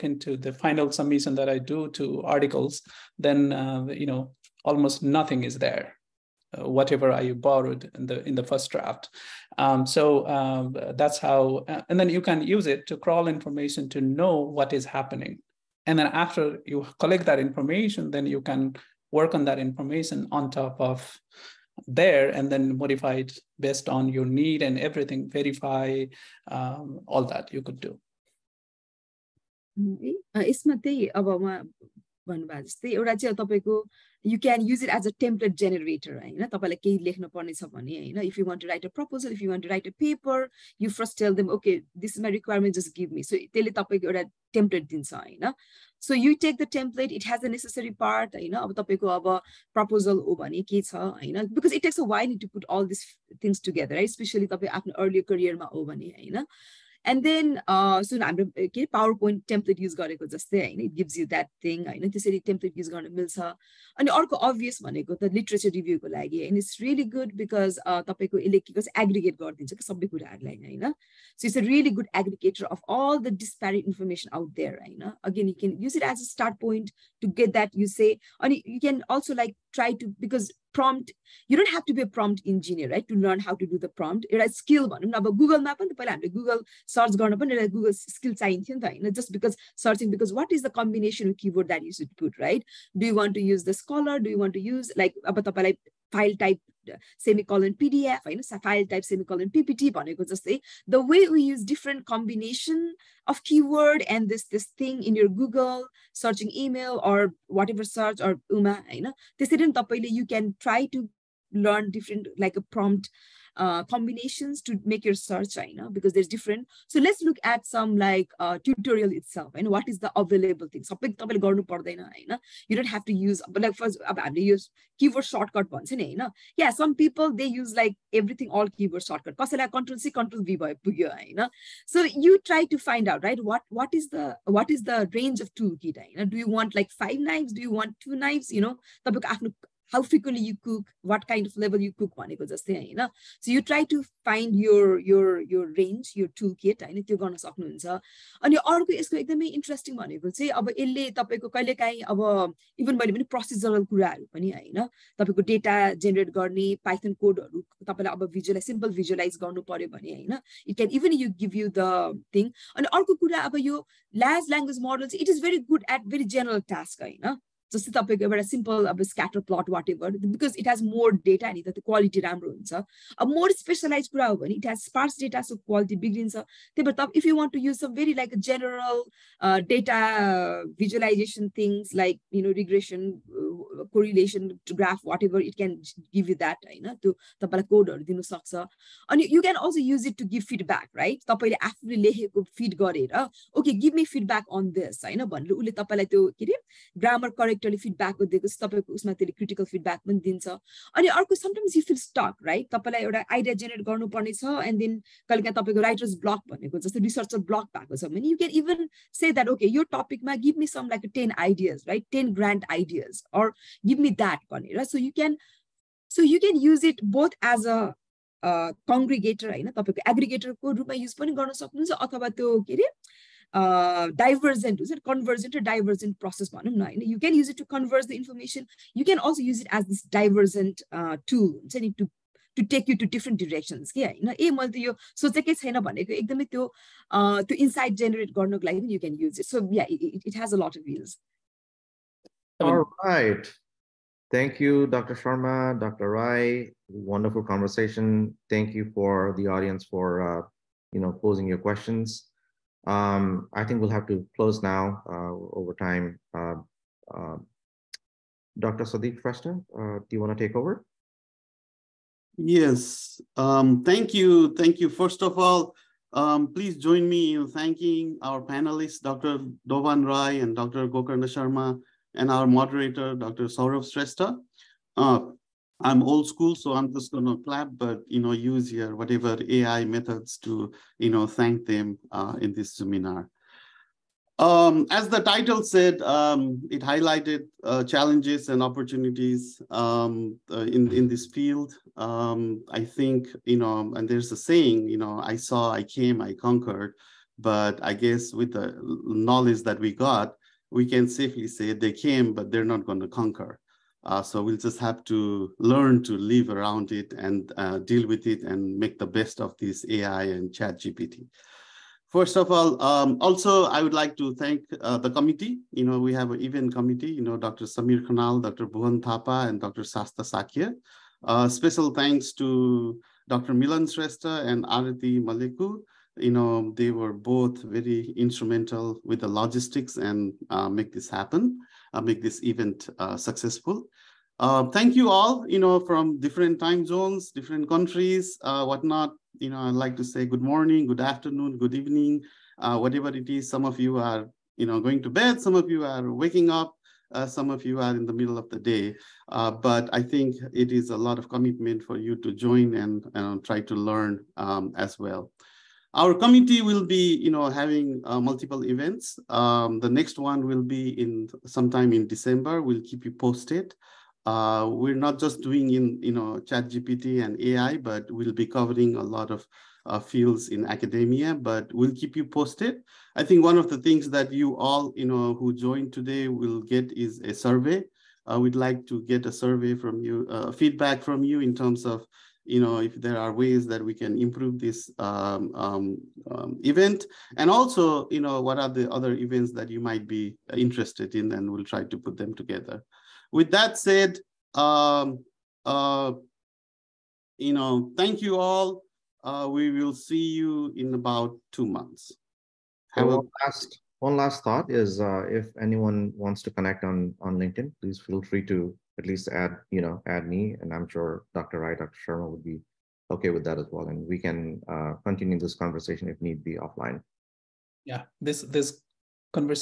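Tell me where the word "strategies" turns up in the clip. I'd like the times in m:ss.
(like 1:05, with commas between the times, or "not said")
not said.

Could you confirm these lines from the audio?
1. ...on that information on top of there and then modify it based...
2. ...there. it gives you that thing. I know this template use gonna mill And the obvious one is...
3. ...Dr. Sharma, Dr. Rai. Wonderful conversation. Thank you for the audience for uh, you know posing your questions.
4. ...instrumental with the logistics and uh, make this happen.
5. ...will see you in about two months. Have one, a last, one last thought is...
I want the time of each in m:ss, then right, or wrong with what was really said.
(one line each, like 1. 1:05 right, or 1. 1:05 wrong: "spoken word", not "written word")
1. 0:19 right
2. 1:00 right
3. 4:04 right
4. 5:28 right
5. 6:39 right.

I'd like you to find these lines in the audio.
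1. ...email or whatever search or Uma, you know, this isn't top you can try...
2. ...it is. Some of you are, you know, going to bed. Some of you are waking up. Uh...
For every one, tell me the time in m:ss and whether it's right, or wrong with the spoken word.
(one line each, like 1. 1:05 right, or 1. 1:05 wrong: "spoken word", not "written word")
1. 1:46 right
2. 5:43 right.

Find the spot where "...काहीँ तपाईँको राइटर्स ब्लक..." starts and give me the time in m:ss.
3:25.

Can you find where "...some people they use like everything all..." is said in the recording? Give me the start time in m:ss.
2:06.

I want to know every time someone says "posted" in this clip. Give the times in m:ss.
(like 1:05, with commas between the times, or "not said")
6:03, 6:12.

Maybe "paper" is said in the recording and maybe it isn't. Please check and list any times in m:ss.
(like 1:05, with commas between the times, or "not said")
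0:39.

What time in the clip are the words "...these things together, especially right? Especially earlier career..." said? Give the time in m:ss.
0:52.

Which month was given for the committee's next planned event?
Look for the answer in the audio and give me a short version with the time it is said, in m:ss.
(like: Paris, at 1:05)
December, at 6:02.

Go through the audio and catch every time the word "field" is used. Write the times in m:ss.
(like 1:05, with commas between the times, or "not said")
4:51, 6:09.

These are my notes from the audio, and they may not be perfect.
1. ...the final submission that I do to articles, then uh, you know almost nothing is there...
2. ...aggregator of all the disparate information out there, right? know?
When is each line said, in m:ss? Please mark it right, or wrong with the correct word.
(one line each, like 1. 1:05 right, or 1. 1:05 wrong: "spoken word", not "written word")
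1. 0:00 right
2. 1:12 right.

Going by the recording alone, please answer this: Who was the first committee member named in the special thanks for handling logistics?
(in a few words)
Dr. Milan Shrestha.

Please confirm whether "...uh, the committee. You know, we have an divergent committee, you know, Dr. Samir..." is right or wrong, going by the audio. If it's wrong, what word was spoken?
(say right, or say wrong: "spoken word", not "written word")
wrong: "event", not "divergent".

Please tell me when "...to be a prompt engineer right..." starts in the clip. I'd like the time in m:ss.
1:21.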